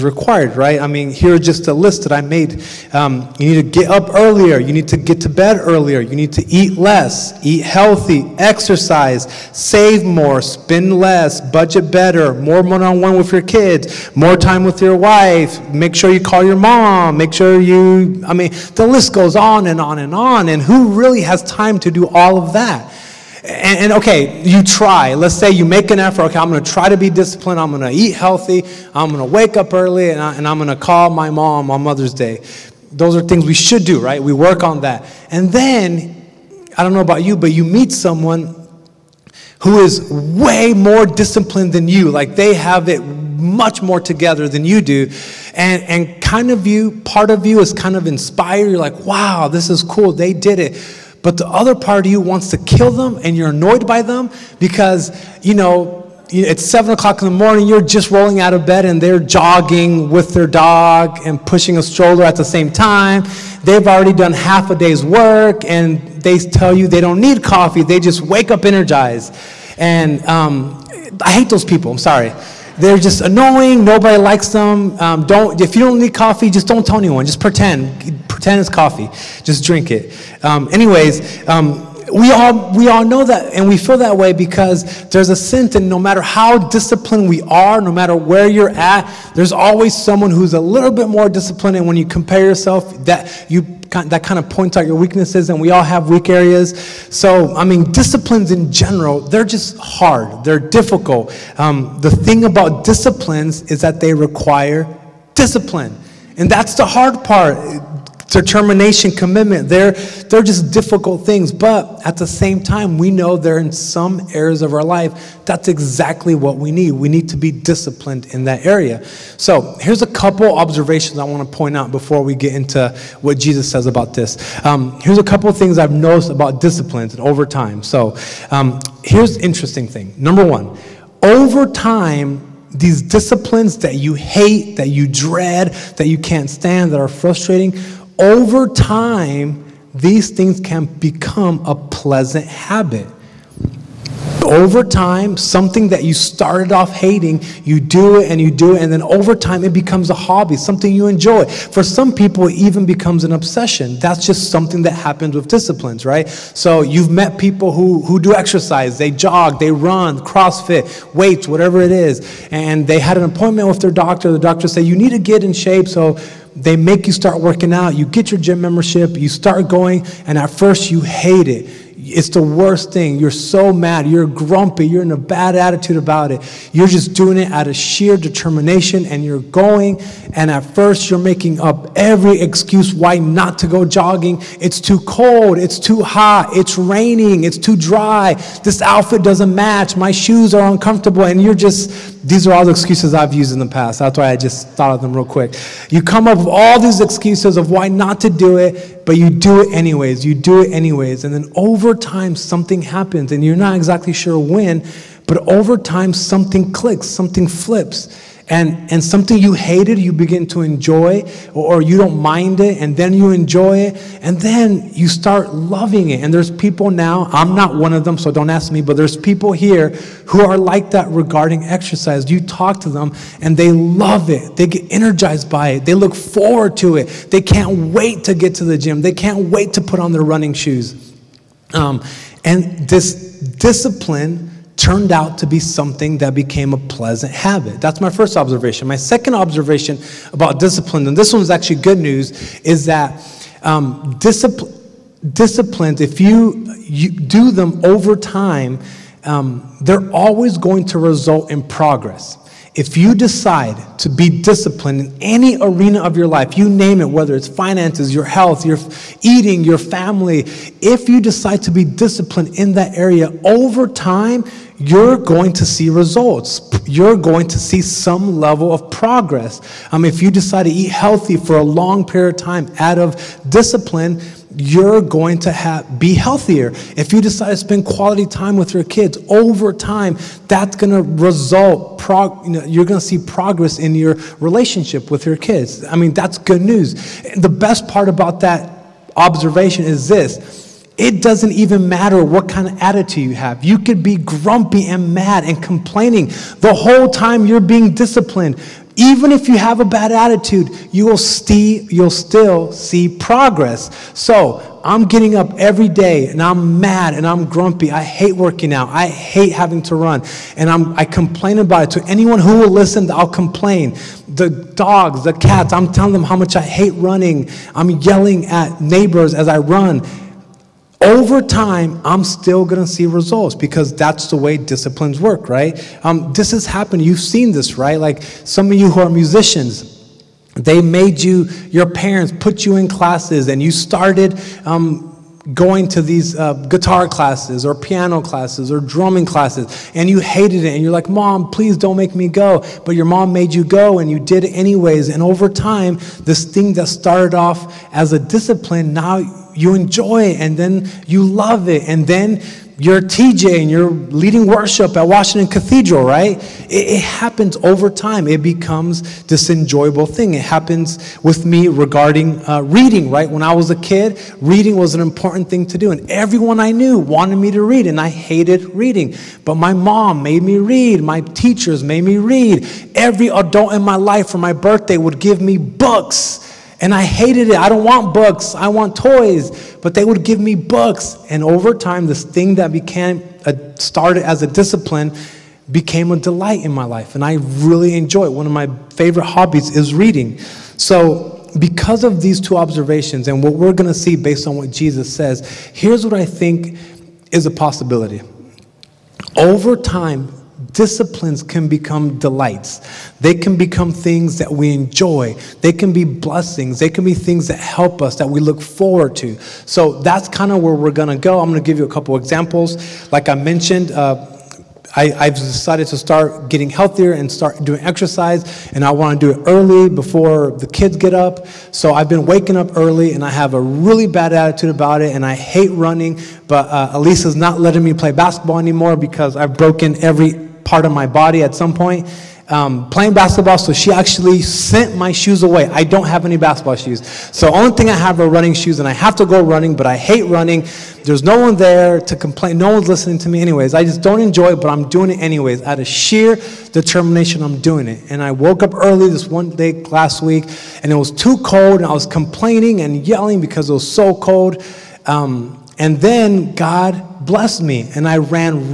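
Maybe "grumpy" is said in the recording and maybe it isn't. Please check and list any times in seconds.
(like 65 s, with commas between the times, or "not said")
174 s, 294 s, 307 s.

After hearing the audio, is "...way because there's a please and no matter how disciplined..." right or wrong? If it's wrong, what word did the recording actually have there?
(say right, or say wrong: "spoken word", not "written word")
wrong: "sense", not "please".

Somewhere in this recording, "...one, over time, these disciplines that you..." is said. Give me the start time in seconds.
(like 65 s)
130 s.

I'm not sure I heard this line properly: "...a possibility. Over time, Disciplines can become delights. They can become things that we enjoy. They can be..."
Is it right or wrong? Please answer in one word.
right.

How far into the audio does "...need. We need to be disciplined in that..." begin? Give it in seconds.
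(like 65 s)
116 s.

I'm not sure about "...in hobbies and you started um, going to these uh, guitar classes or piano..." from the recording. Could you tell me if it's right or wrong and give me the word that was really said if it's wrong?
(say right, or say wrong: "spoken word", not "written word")
wrong: "classes", not "hobbies".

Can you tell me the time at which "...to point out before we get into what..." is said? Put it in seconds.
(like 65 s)
121 s.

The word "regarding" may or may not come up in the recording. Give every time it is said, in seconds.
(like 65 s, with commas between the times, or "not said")
221 s, 361 s.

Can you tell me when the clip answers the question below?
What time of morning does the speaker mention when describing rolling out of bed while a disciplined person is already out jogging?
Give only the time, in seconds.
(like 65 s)
56 s.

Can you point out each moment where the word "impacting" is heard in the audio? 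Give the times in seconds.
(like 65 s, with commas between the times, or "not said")
not said.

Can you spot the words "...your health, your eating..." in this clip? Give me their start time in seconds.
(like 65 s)
258 s.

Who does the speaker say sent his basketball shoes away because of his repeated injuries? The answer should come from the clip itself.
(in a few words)
Elisa.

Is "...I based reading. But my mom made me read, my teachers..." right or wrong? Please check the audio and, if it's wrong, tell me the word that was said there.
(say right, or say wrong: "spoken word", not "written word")
wrong: "hated", not "based".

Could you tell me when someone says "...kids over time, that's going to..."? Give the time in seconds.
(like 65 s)
278 s.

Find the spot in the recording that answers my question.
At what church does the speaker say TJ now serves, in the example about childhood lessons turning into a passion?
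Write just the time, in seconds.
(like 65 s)
355 s.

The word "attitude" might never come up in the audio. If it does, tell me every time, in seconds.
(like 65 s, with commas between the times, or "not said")
175 s, 292 s, 300 s, 424 s.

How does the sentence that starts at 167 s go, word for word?
You get your gym membership, you start going, and at first, you hate it it's the worst thing.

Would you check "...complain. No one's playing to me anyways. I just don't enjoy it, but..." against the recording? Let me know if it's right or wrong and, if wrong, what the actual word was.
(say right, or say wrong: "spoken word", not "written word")
wrong: "listening", not "playing".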